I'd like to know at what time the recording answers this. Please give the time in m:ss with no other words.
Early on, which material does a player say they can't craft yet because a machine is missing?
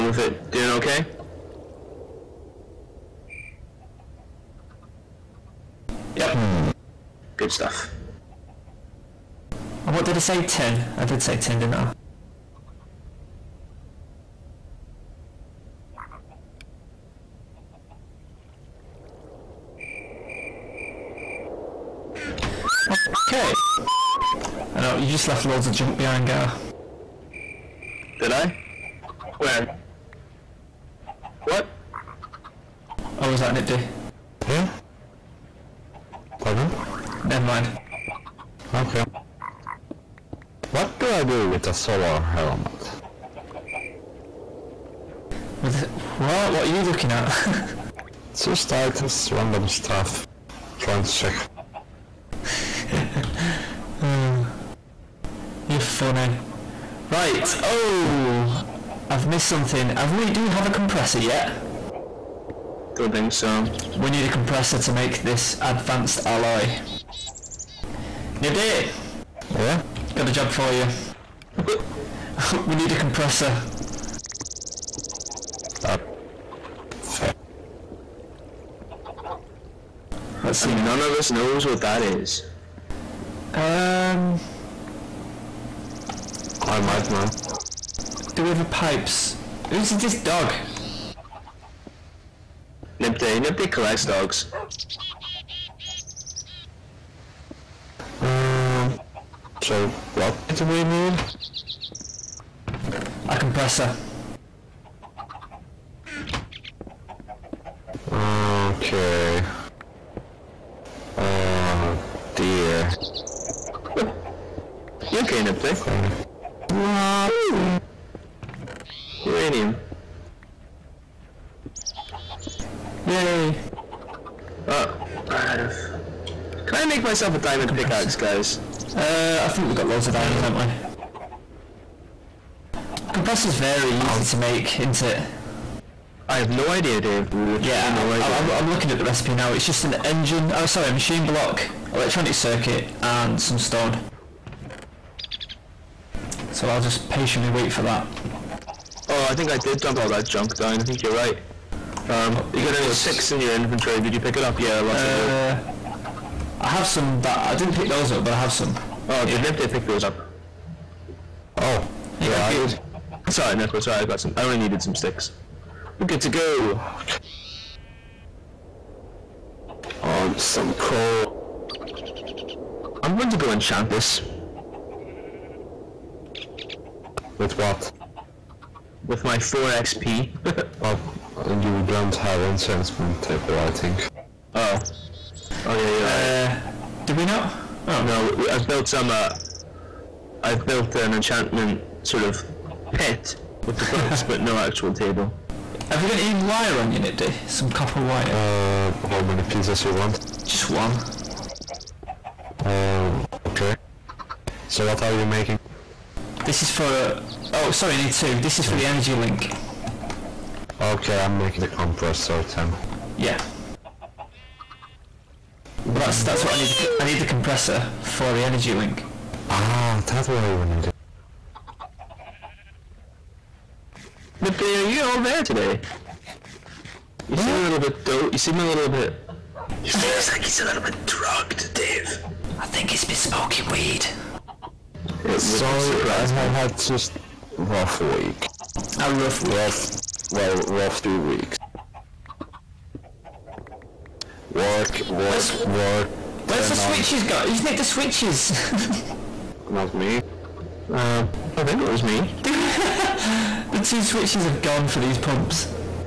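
1:05.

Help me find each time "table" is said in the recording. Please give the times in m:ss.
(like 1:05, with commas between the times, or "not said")
3:03, 3:14.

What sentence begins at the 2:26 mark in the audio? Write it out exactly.
So I'll just patiently wait for that.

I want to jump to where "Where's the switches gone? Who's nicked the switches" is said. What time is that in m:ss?
4:06.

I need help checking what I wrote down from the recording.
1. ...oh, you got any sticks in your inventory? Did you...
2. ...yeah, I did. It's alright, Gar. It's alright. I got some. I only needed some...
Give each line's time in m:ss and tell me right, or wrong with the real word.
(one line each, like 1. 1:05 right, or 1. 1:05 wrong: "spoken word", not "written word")
1. 2:32 right
2. 2:42 wrong: "Nipde", not "Gar".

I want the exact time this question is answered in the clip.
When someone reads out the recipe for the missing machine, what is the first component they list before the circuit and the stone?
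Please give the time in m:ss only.
2:20.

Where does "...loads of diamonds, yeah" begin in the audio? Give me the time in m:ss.
2:09.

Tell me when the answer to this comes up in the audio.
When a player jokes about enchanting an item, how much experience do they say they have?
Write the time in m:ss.
2:59.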